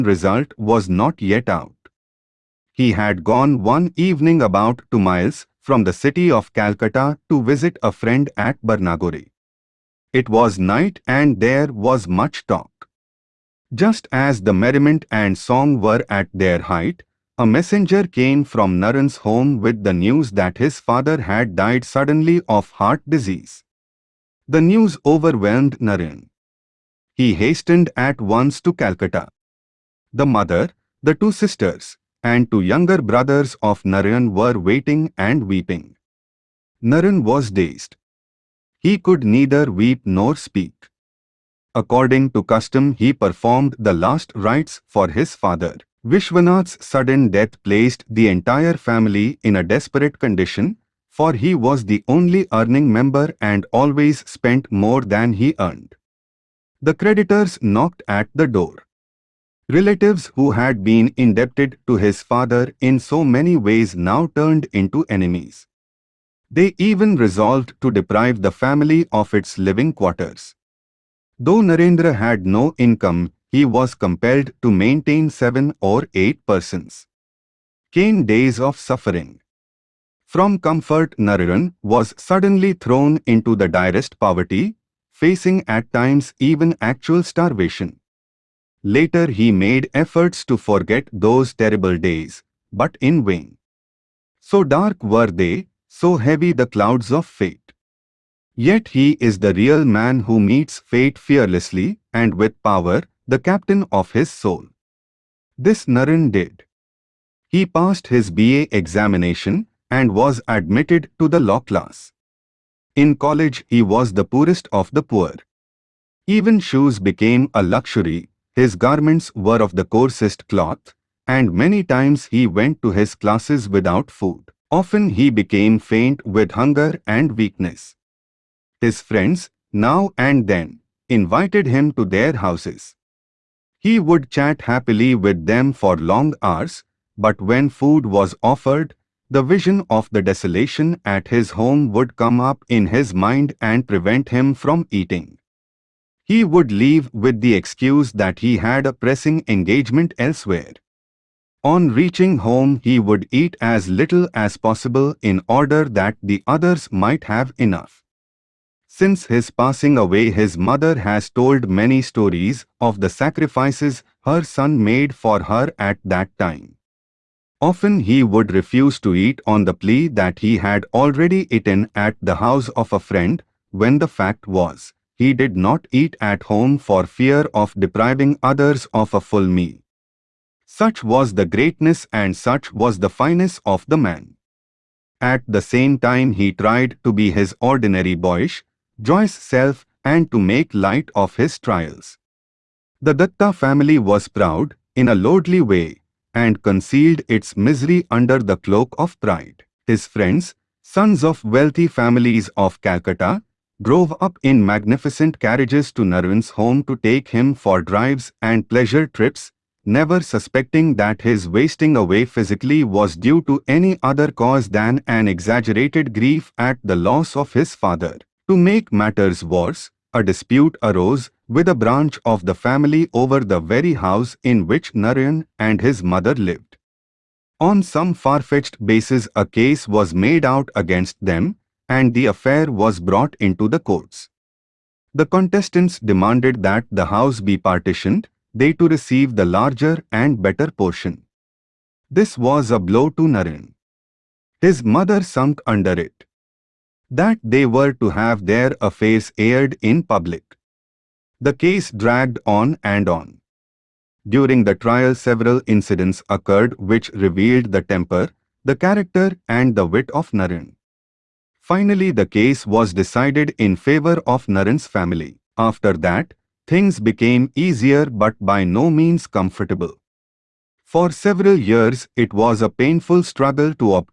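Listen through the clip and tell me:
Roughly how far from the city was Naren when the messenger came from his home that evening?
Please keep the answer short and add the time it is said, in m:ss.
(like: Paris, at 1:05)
2 miles, at 0:04.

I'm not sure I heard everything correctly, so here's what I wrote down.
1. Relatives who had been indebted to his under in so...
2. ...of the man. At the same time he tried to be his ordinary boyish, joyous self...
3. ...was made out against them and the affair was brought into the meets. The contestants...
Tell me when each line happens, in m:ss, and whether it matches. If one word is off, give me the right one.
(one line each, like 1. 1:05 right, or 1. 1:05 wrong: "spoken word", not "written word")
1. 0:59 wrong: "father", not "under"
2. 3:03 right
3. 3:49 wrong: "courts", not "meets".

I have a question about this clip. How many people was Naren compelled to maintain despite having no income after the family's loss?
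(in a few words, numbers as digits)
7 or 8.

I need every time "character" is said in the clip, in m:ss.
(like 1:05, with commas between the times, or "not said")
4:18.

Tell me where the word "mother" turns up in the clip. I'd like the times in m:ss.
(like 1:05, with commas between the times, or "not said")
0:30, 2:40, 3:46, 4:04.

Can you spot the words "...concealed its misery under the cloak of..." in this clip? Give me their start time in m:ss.
3:16.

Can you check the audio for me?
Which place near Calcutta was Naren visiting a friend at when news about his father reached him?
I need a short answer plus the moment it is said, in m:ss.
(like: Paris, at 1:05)
Barnagore, at 0:08.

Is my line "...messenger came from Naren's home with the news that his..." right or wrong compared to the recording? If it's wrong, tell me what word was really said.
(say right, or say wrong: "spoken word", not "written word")
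right.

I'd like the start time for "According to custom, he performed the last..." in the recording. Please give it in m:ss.
0:41.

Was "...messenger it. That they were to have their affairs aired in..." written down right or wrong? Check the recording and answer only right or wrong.
wrong.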